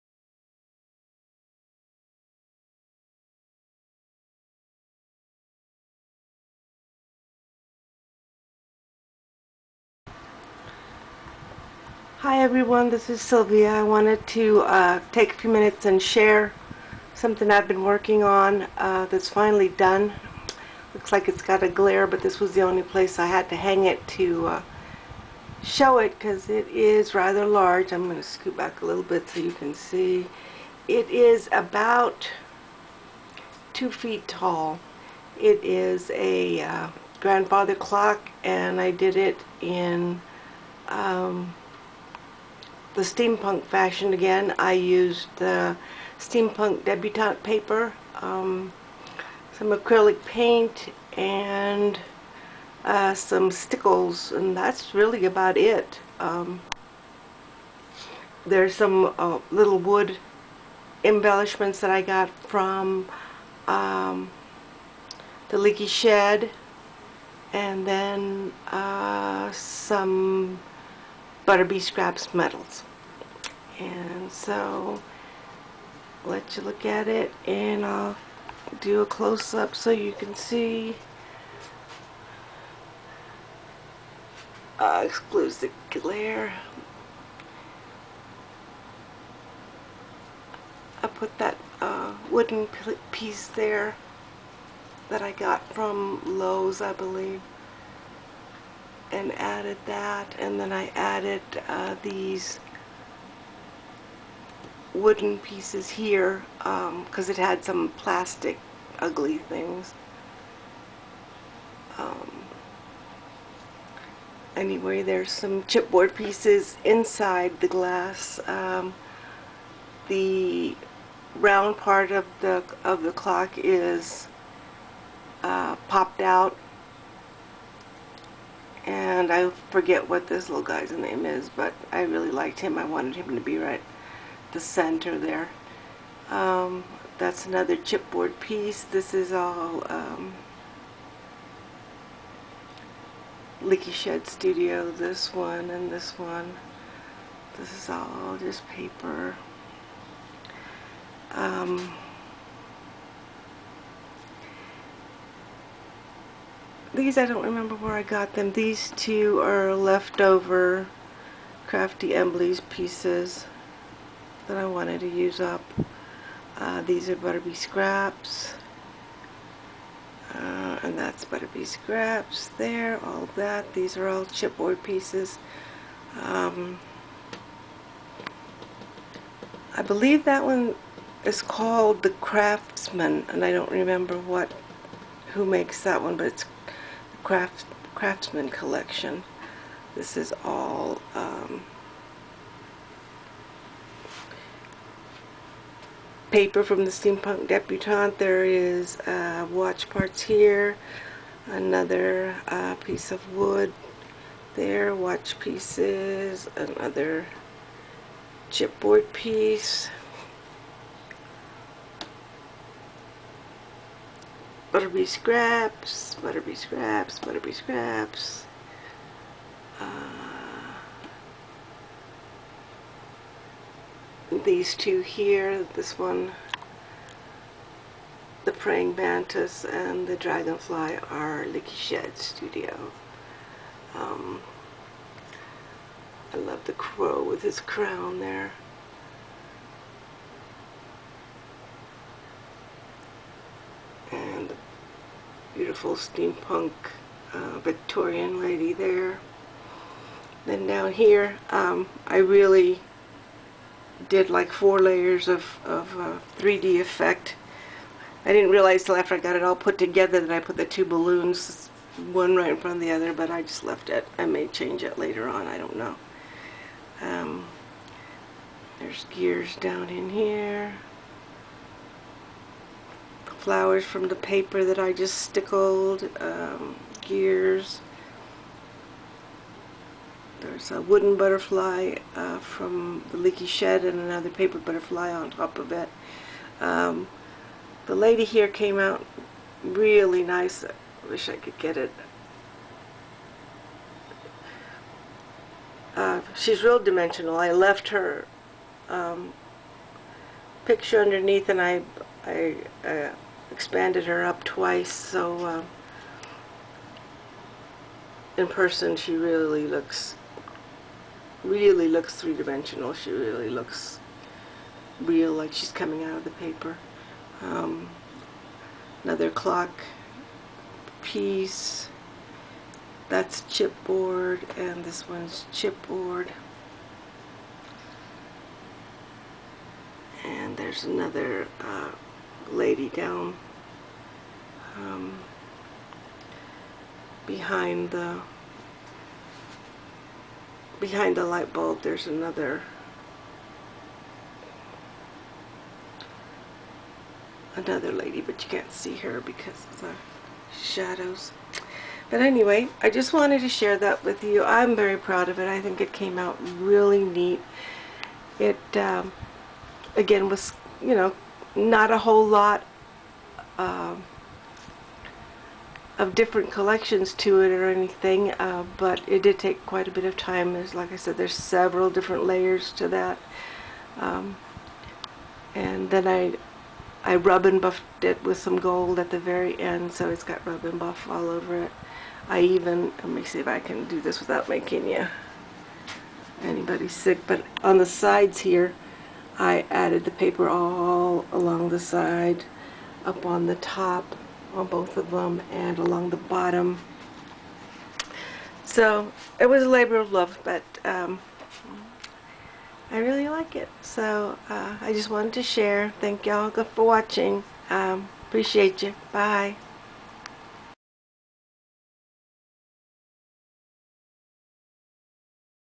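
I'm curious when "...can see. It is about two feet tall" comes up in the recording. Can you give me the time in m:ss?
0:29.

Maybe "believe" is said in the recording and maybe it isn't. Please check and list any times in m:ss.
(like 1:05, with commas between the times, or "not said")
1:36, 2:59.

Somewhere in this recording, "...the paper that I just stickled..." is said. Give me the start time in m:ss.
4:34.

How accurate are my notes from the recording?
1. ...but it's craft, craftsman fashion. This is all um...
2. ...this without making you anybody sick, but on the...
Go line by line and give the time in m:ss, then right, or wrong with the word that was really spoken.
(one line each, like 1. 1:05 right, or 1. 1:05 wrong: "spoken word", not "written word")
1. 3:06 wrong: "collection", not "fashion"
2. 6:24 right.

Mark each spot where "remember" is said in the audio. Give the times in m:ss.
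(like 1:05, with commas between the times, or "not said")
2:37, 3:03.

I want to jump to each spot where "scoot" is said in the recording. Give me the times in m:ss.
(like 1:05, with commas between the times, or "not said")
0:28.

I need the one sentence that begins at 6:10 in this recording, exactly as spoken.
As like I said, there's several different layers to that.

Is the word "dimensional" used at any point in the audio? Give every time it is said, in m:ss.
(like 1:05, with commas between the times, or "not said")
4:56, 5:12.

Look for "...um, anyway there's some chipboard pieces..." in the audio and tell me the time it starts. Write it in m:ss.
1:51.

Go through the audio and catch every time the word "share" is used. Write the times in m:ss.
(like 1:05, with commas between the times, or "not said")
0:15, 5:53, 6:45.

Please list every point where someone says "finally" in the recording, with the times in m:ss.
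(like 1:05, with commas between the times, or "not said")
0:19.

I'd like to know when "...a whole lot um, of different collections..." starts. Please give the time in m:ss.
6:01.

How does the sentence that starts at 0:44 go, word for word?
I used the steampunk debutante paper, um, some acrylic paint, and uh, some stickles, and that's really about it.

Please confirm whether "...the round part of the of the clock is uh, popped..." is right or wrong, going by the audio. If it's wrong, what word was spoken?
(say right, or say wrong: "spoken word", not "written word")
right.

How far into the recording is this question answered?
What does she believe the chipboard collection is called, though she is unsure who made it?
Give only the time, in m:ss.
3:02.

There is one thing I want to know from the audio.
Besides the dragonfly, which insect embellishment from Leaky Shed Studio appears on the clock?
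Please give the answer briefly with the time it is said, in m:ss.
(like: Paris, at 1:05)
Praying Mantis, at 3:48.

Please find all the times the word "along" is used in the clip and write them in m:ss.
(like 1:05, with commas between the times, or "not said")
6:31, 6:35.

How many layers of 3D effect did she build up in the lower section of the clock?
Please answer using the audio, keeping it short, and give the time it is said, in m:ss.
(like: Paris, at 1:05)
4, at 4:14.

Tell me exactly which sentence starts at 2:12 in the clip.
I wanted him to be right the center there.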